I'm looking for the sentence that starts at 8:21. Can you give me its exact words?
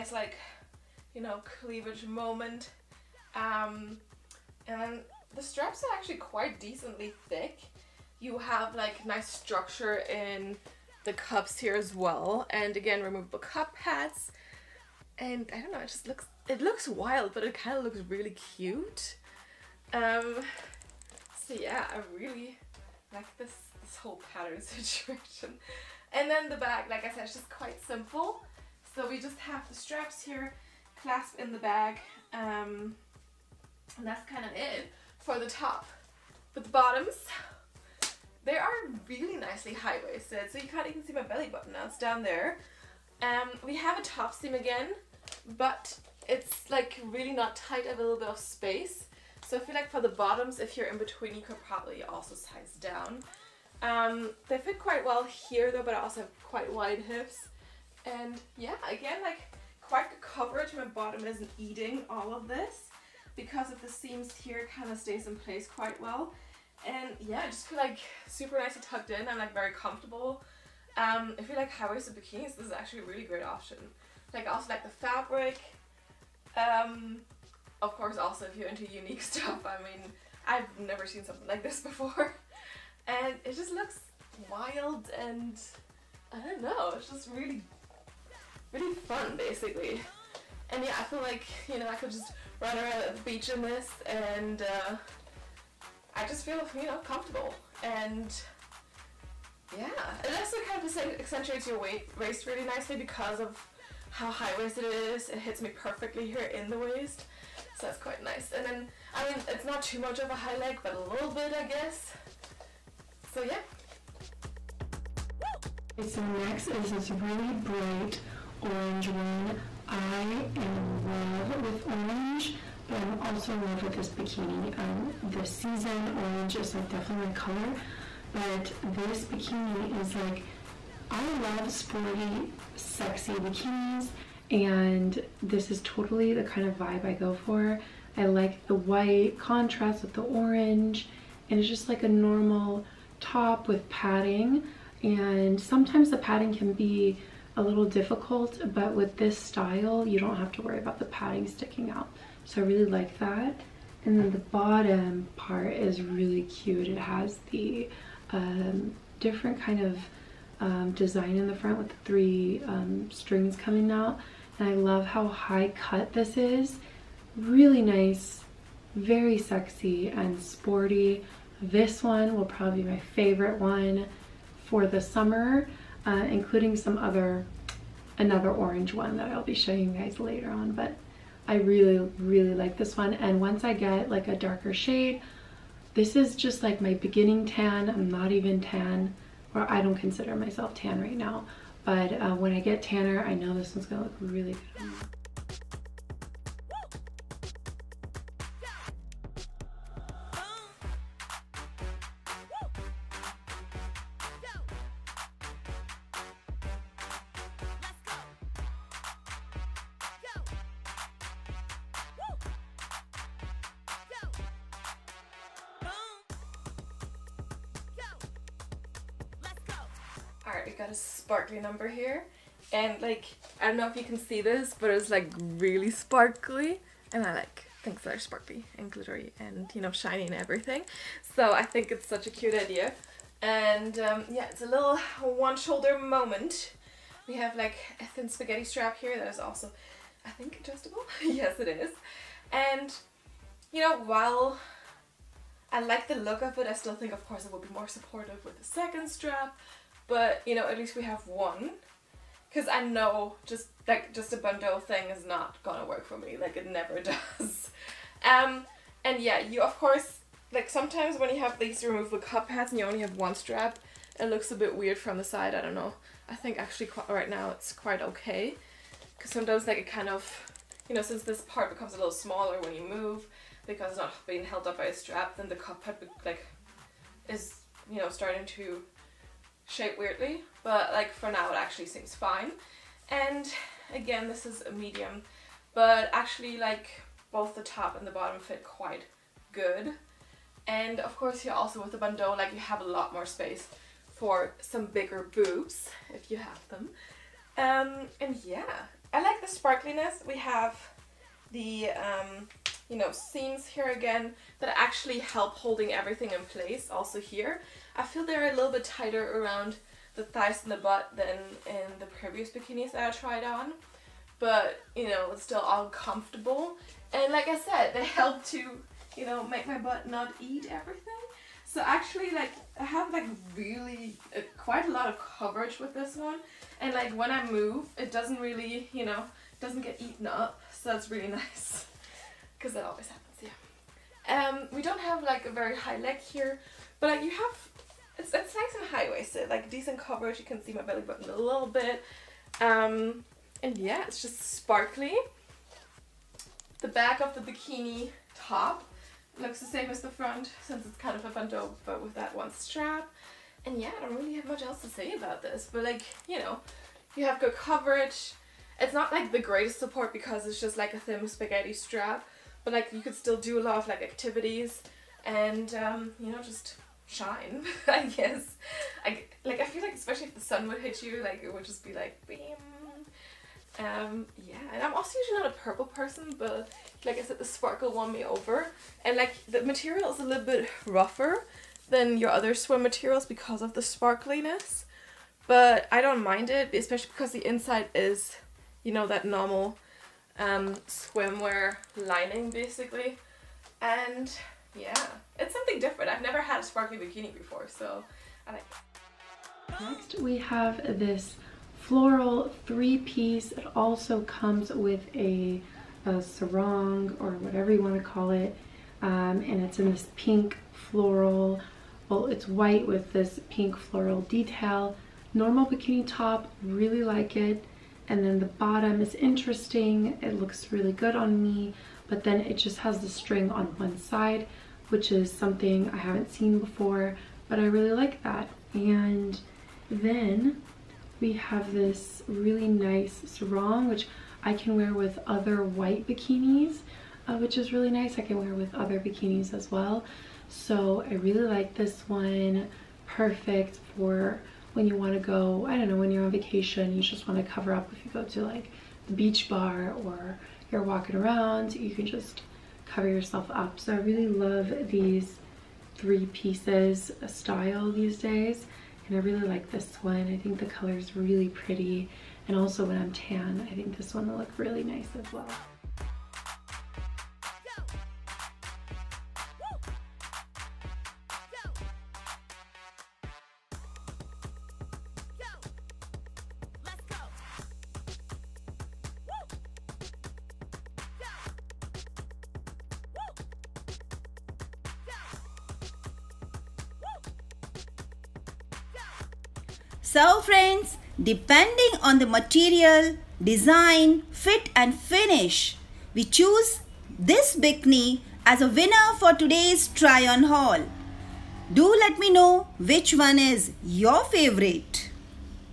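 Do let me know which one is your favorite.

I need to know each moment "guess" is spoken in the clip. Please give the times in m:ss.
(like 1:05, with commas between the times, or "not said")
1:51, 6:08.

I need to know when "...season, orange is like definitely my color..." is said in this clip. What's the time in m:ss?
2:05.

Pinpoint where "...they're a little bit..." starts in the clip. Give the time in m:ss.
5:08.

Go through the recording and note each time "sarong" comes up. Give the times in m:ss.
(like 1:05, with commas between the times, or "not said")
6:46, 7:13.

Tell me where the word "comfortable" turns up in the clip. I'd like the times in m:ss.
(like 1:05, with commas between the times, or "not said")
1:09, 1:37, 5:15.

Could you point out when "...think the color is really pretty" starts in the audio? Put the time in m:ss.
7:40.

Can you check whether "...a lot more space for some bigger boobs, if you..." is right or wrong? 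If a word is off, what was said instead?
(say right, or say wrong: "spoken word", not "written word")
right.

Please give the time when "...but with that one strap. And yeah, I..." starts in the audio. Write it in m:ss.
5:51.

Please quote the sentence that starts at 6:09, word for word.
I, like I feel like especially if the sun would hit you, like it would just be like beam.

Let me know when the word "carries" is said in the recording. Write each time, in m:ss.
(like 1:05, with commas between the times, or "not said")
not said.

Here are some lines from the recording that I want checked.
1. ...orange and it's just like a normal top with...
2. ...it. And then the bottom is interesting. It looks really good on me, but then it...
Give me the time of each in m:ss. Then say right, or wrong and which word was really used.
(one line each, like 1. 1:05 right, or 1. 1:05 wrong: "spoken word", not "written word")
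1. 2:20 right
2. 6:57 right.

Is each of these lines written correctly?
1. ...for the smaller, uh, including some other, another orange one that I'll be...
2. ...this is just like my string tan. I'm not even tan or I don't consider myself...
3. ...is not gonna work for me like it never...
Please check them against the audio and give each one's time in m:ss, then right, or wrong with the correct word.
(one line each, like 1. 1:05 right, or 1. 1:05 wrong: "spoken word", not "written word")
1. 2:54 wrong: "summer", not "smaller"
2. 3:05 wrong: "beginning", not "string"
3. 4:15 right.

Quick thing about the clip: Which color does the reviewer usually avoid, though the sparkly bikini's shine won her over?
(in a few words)
purple.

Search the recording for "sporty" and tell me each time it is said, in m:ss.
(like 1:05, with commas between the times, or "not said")
2:11, 2:50.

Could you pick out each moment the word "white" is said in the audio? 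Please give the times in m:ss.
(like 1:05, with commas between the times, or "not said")
2:18, 6:52, 7:15.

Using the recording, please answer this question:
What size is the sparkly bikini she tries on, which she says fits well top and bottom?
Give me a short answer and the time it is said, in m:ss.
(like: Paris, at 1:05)
medium, at 4:44.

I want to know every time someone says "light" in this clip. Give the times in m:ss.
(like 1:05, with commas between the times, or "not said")
not said.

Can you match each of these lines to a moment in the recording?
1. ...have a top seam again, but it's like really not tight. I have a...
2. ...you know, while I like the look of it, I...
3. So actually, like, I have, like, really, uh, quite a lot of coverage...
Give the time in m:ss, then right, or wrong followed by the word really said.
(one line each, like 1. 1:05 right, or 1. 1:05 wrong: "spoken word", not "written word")
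1. 0:43 right
2. 4:03 right
3. 5:21 right.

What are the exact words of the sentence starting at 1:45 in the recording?
It hits me perfectly here in the waist.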